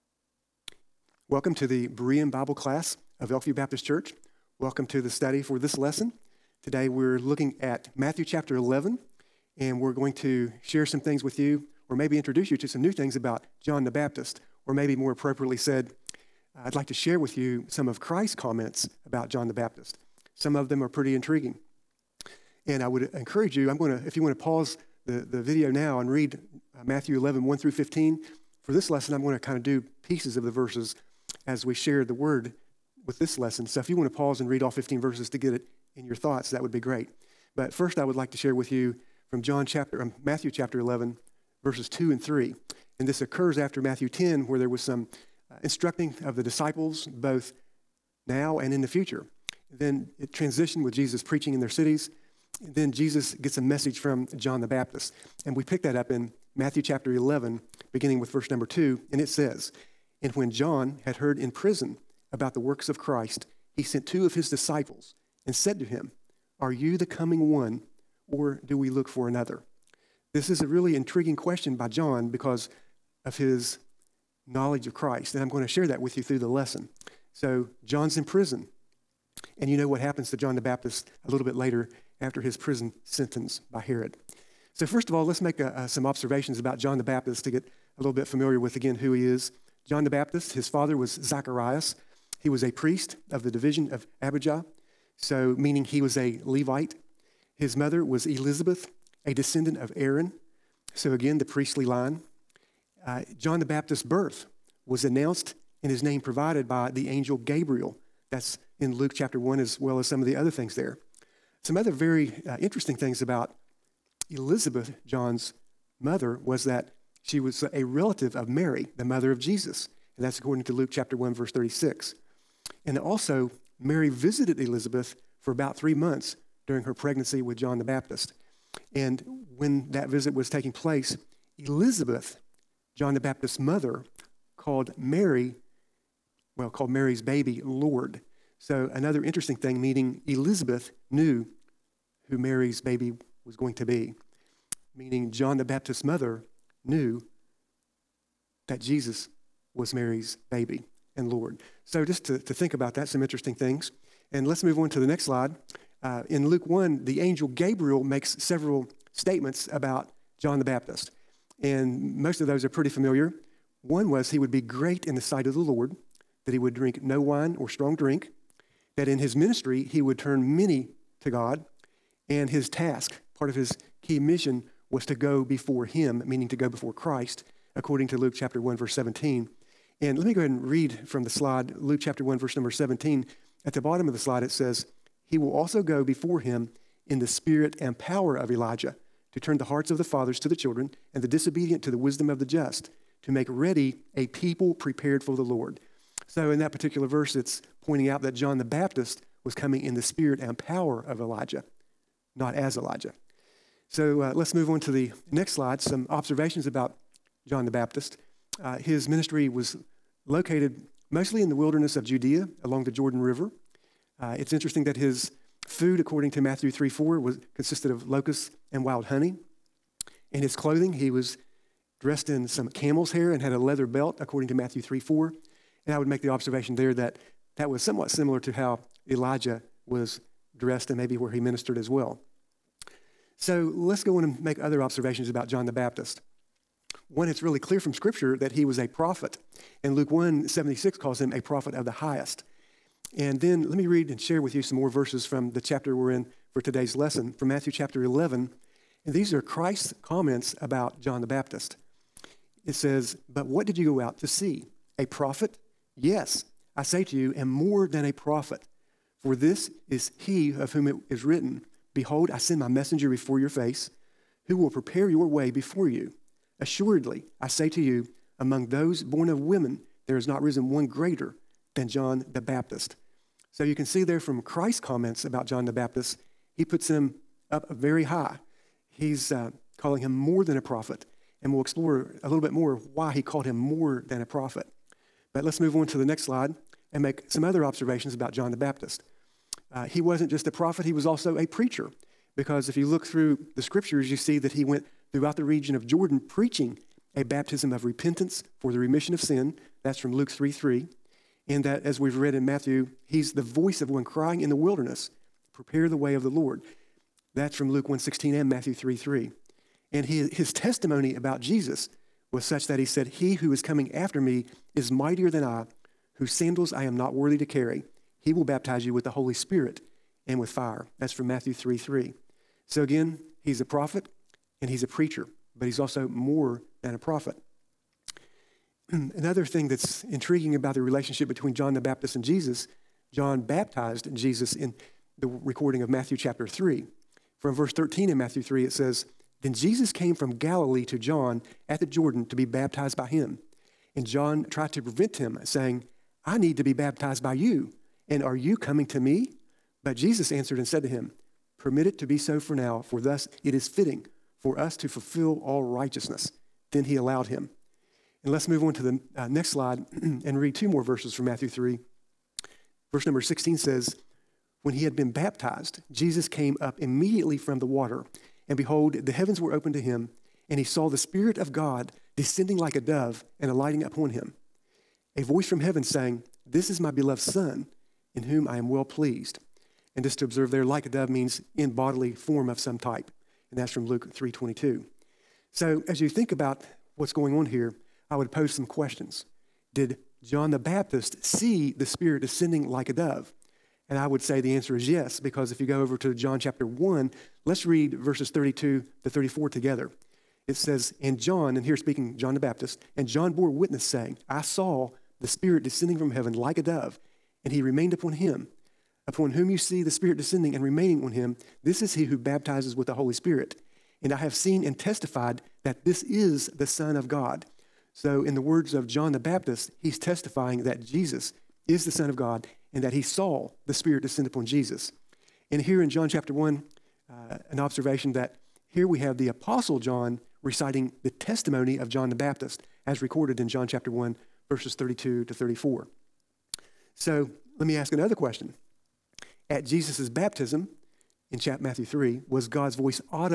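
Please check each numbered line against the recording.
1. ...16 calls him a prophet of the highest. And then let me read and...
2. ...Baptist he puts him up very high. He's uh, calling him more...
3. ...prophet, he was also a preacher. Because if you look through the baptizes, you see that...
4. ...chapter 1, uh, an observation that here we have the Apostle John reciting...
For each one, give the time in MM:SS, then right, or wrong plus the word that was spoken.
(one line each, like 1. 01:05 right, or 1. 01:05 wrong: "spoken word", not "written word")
1. 04:00 wrong: "76", not "16"
2. 04:35 right
3. 04:50 wrong: "scriptures", not "baptizes"
4. 07:06 right.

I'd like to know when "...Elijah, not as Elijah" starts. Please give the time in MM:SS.
03:21.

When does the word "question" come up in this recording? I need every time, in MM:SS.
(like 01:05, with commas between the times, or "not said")
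01:11, 06:28, 07:18.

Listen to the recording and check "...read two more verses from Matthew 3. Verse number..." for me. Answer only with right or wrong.
right.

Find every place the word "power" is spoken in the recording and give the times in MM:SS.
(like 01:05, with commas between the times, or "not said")
03:07, 03:20.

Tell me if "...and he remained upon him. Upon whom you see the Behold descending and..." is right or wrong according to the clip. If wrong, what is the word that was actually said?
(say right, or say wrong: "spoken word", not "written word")
wrong: "Spirit", not "Behold".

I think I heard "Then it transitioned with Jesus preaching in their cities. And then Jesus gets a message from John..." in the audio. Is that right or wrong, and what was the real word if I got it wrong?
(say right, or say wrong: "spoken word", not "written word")
right.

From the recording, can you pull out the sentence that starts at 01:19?
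And you know what happens to John the Baptist a little bit later after his prison sentence by Herod.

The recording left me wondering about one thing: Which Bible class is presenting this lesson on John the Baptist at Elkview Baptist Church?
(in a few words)
Berean Bible class.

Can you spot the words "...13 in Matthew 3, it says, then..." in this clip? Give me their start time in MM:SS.
05:37.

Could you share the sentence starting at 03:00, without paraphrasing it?
And let me go ahead and read from the slide, Luke chapter 1, verse number 17.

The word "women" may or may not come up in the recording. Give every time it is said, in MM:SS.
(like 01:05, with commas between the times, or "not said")
04:29.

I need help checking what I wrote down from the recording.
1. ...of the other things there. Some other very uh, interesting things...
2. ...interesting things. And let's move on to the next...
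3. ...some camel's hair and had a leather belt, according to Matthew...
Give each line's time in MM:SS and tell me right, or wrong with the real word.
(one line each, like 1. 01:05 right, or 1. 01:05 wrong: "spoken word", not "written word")
1. 01:50 right
2. 02:33 right
3. 03:42 right.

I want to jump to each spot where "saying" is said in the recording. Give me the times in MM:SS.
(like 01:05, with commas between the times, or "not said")
05:45, 06:15, 06:43.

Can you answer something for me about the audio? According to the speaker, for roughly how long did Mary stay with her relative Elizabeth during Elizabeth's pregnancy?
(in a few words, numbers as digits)
3 months.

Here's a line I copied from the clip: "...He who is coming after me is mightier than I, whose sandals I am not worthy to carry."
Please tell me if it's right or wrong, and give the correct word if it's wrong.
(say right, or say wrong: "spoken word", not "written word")
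right.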